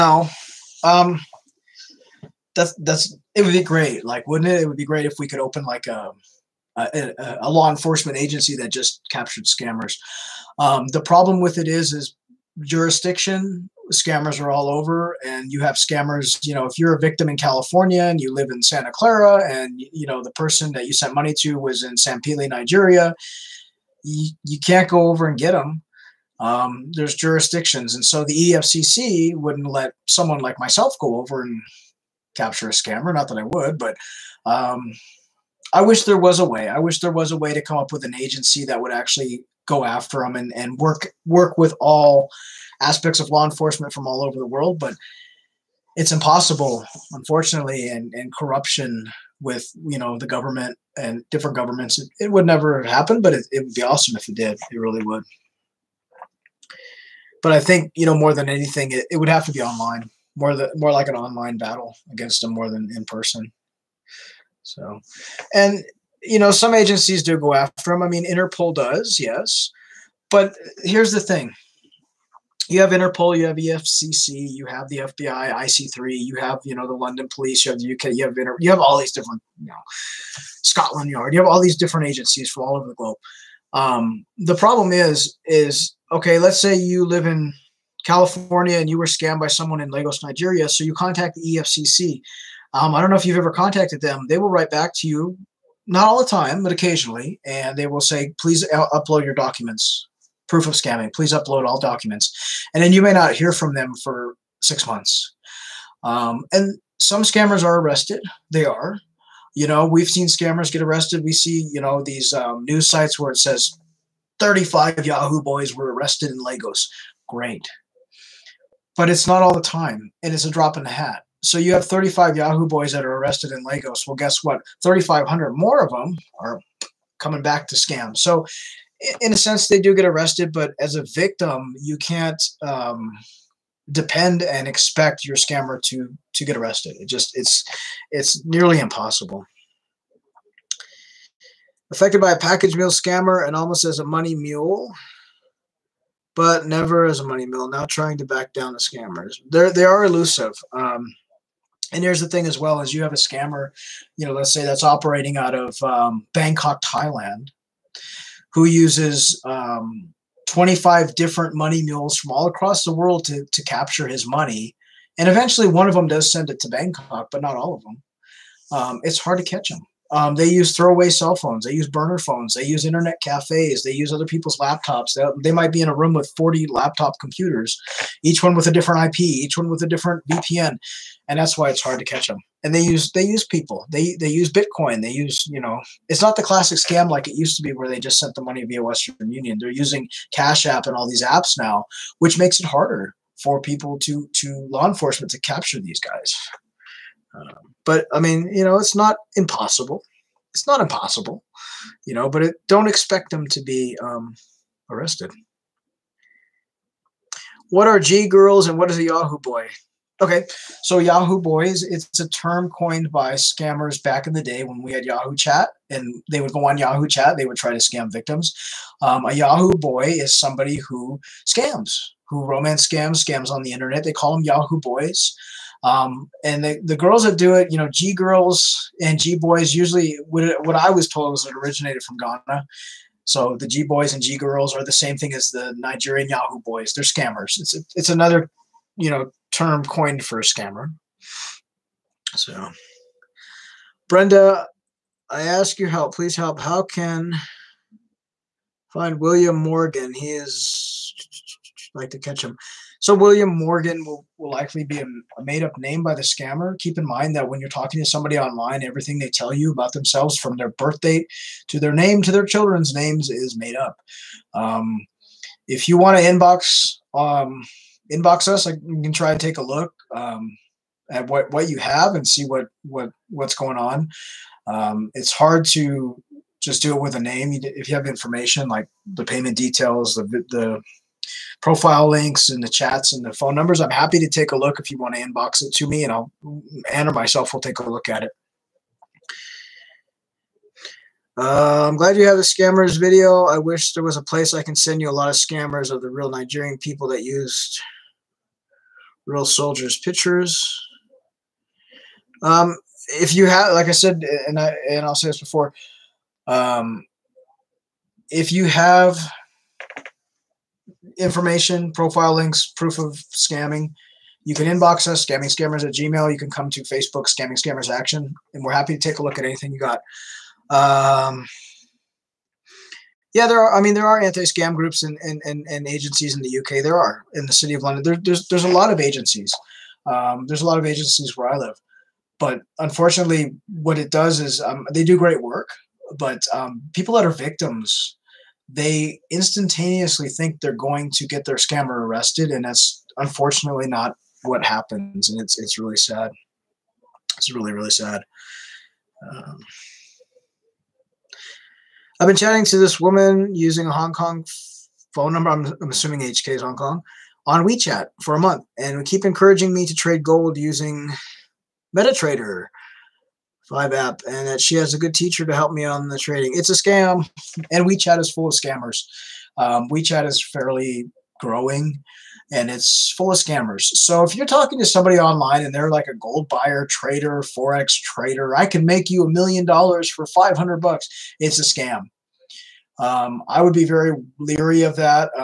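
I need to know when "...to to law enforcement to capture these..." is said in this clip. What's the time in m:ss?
3:13.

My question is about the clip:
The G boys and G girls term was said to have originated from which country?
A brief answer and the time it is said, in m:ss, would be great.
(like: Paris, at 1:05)
Ghana, at 3:52.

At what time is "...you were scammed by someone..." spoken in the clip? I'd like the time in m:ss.
1:28.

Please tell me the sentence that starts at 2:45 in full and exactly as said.
And eventually one of them does send it to Bangkok, but not all of them.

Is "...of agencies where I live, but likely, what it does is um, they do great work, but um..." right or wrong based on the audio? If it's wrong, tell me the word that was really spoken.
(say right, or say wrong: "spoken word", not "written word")
wrong: "unfortunately", not "likely".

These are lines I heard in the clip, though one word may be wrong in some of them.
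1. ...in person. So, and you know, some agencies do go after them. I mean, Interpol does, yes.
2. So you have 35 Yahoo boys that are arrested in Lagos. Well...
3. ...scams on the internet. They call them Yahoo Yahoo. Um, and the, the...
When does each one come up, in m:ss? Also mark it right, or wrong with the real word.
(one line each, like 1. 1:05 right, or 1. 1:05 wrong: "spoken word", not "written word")
1. 1:02 right
2. 2:01 right
3. 3:43 wrong: "Boys", not "Yahoo".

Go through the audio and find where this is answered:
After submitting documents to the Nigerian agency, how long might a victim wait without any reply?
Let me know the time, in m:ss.
1:44.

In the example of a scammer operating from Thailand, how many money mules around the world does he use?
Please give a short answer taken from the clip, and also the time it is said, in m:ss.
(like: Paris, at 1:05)
25, at 2:40.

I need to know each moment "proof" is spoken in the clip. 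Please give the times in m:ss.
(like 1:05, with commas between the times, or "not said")
1:40, 5:12.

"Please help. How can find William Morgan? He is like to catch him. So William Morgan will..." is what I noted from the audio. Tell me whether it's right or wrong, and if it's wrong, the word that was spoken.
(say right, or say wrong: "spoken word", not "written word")
right.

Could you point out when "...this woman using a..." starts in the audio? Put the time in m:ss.
5:52.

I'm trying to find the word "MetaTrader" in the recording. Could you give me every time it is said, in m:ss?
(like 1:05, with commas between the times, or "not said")
6:01.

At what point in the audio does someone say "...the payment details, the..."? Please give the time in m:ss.
4:39.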